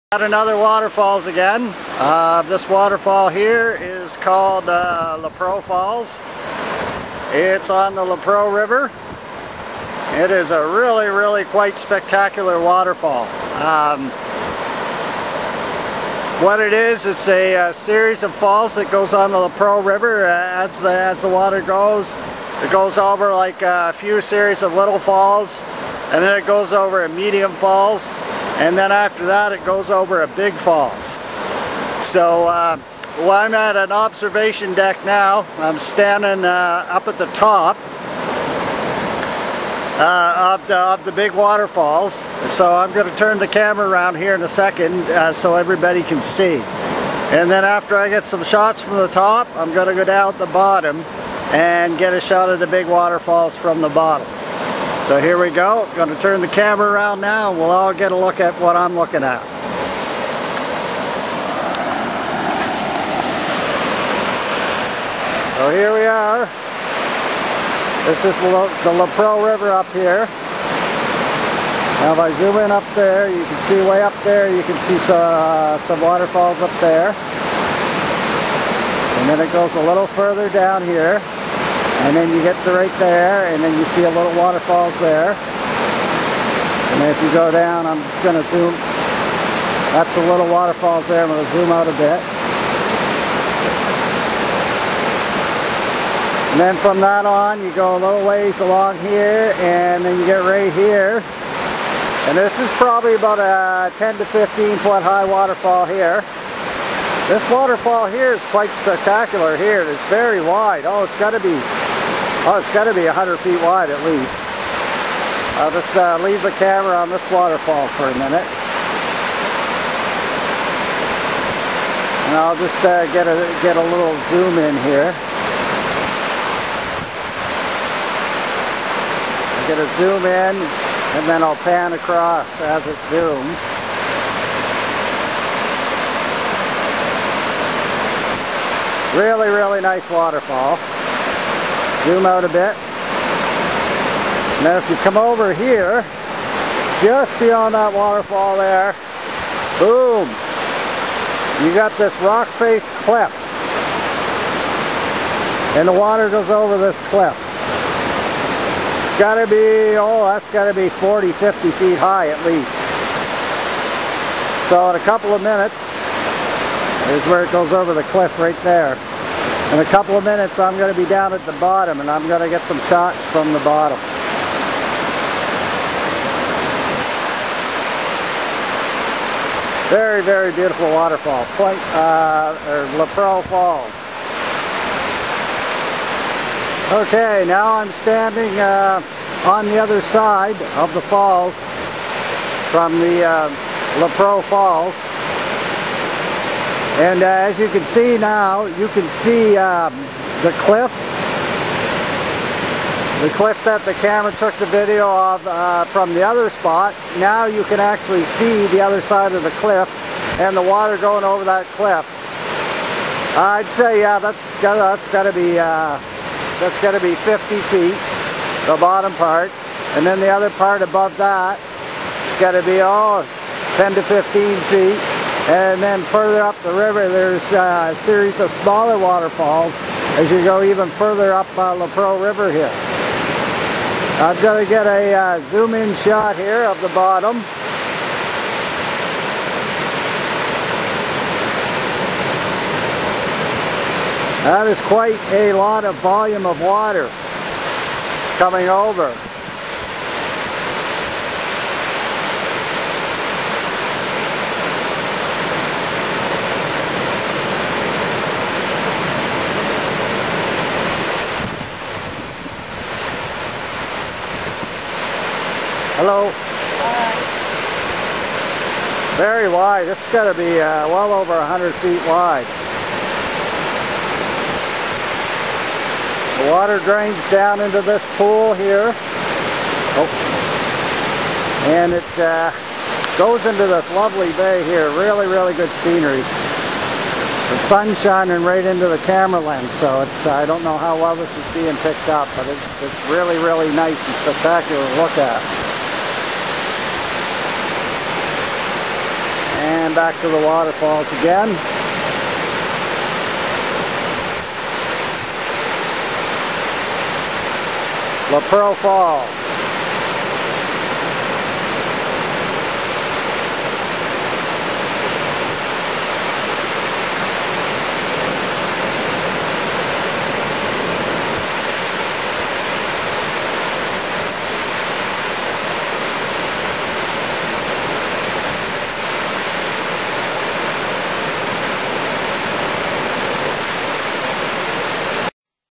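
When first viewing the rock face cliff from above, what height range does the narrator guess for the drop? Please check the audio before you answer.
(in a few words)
40 to 50 feet.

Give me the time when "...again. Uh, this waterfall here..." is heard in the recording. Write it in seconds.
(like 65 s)
1 s.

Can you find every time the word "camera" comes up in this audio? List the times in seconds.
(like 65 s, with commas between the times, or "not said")
43 s, 56 s, 116 s, 204 s, 289 s.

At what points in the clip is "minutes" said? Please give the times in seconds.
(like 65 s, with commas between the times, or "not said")
118 s, 165 s, 170 s.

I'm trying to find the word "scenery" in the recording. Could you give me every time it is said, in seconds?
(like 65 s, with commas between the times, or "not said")
285 s.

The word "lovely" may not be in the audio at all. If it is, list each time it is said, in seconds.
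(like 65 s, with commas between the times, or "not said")
283 s.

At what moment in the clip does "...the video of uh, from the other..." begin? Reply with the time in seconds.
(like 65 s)
204 s.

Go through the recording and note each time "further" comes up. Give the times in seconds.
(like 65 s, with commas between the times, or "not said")
80 s, 226 s, 230 s.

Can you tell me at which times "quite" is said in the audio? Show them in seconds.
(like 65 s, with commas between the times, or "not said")
11 s, 108 s, 244 s.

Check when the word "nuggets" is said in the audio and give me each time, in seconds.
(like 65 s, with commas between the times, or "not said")
not said.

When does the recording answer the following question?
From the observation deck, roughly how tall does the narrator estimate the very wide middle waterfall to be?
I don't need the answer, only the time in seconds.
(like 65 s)
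103 s.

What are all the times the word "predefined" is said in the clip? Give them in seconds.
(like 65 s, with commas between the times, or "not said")
not said.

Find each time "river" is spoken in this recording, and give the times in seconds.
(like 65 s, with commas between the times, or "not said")
8 s, 19 s, 69 s, 226 s, 232 s.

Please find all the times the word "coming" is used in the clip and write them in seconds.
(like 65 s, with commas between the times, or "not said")
248 s.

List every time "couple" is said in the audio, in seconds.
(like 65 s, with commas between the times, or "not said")
165 s, 169 s.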